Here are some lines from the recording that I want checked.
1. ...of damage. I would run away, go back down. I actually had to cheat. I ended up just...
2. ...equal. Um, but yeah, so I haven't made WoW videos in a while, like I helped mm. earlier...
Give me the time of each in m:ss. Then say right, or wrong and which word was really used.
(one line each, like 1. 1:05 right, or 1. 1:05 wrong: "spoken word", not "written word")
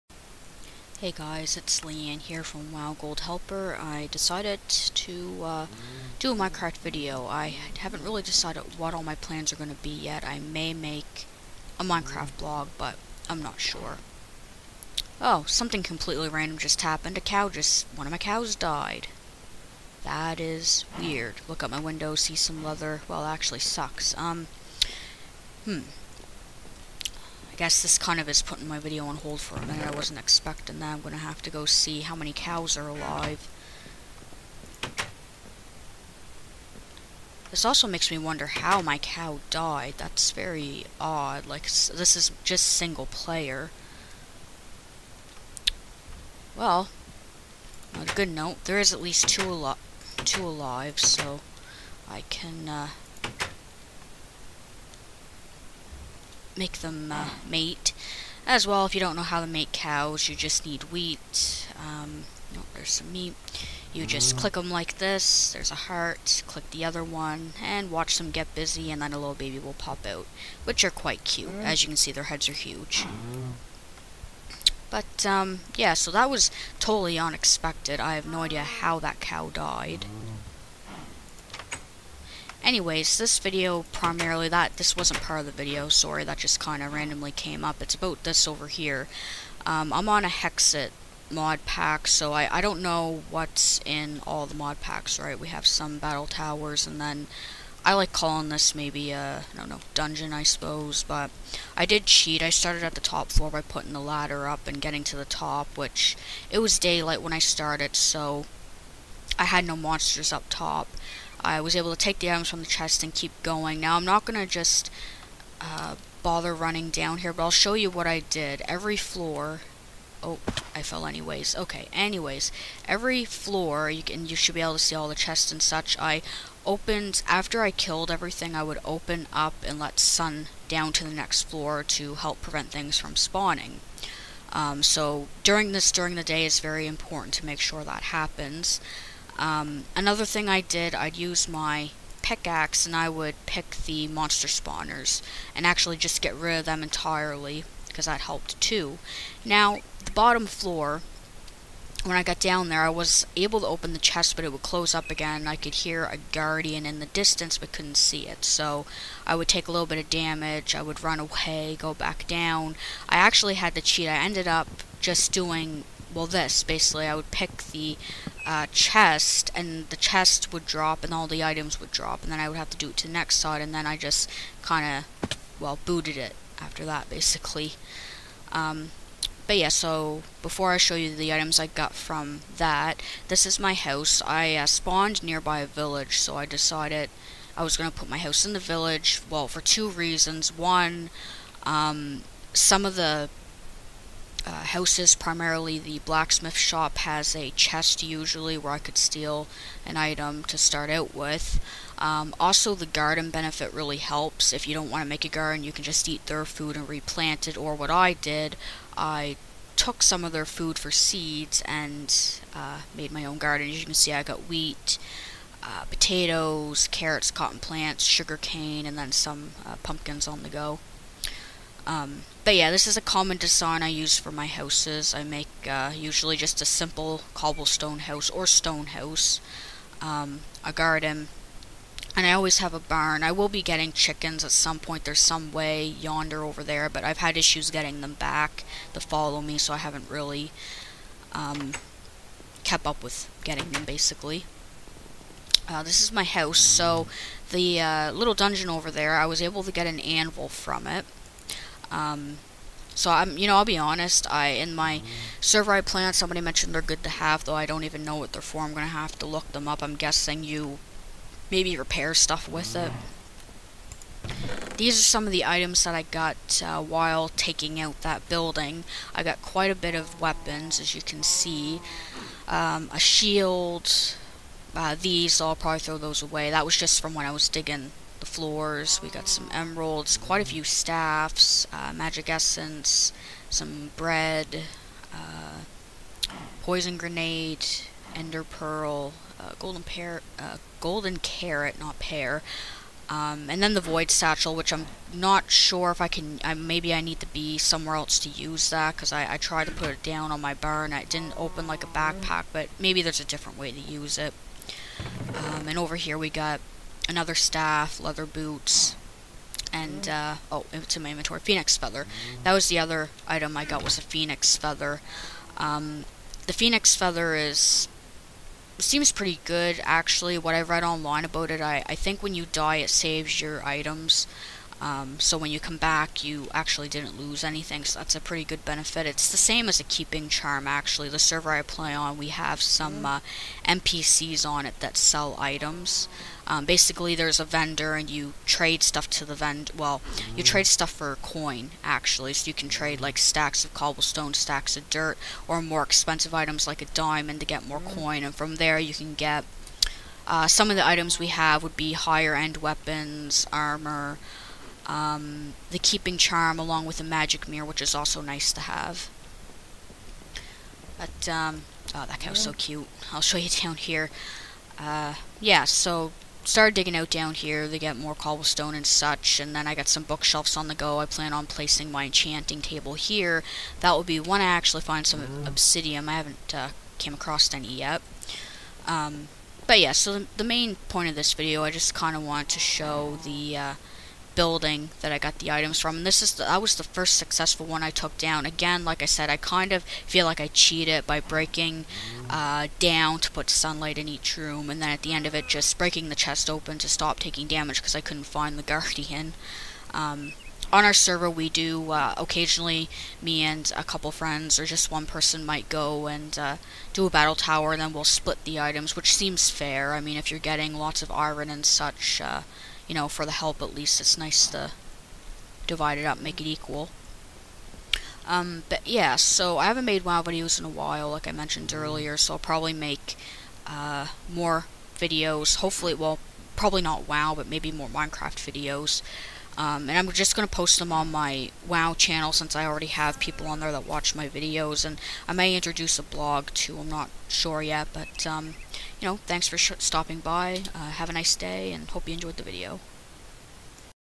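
1. 2:39 right
2. 6:56 wrong: "mentioned", not "helped".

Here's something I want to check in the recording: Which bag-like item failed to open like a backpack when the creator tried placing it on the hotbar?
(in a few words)
void satchel.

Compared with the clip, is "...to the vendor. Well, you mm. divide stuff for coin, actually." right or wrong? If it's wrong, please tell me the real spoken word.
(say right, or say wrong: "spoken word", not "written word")
wrong: "trade", not "divide".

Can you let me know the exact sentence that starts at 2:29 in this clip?
Now, the bottom floor, when I got down there, I was able to open the chest, but it would close up again.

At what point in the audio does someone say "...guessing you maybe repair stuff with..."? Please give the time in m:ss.
4:19.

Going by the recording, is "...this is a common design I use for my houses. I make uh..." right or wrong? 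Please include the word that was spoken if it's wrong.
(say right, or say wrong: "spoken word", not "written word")
right.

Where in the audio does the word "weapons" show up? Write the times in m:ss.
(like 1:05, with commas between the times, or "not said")
4:30, 5:52.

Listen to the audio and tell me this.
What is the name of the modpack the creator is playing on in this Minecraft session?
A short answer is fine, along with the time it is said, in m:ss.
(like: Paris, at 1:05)
Hexxit, at 1:30.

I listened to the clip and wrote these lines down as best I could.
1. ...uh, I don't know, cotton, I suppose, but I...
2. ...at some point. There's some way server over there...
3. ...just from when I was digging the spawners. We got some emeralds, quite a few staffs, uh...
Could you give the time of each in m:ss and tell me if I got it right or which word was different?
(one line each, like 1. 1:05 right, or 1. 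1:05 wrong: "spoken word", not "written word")
1. 1:39 wrong: "dungeon", not "cotton"
2. 3:54 wrong: "yonder", not "server"
3. 4:36 wrong: "floors", not "spawners".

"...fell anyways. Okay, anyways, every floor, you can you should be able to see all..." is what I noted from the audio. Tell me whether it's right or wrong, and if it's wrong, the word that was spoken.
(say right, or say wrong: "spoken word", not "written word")
right.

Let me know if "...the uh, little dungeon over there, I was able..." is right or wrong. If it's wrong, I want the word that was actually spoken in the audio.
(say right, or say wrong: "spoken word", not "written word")
right.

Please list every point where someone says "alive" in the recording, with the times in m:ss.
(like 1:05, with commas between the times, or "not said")
0:32, 0:50.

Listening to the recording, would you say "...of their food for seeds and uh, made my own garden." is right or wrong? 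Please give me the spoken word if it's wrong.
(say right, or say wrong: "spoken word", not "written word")
right.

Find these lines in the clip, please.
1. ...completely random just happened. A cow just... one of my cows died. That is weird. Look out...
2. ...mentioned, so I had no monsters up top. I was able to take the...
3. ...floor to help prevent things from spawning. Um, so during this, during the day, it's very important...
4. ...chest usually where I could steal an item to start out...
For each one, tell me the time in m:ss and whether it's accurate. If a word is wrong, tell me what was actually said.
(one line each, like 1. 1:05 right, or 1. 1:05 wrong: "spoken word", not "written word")
1. 0:15 right
2. 1:47 wrong: "started", not "mentioned"
3. 2:11 right
4. 3:17 right.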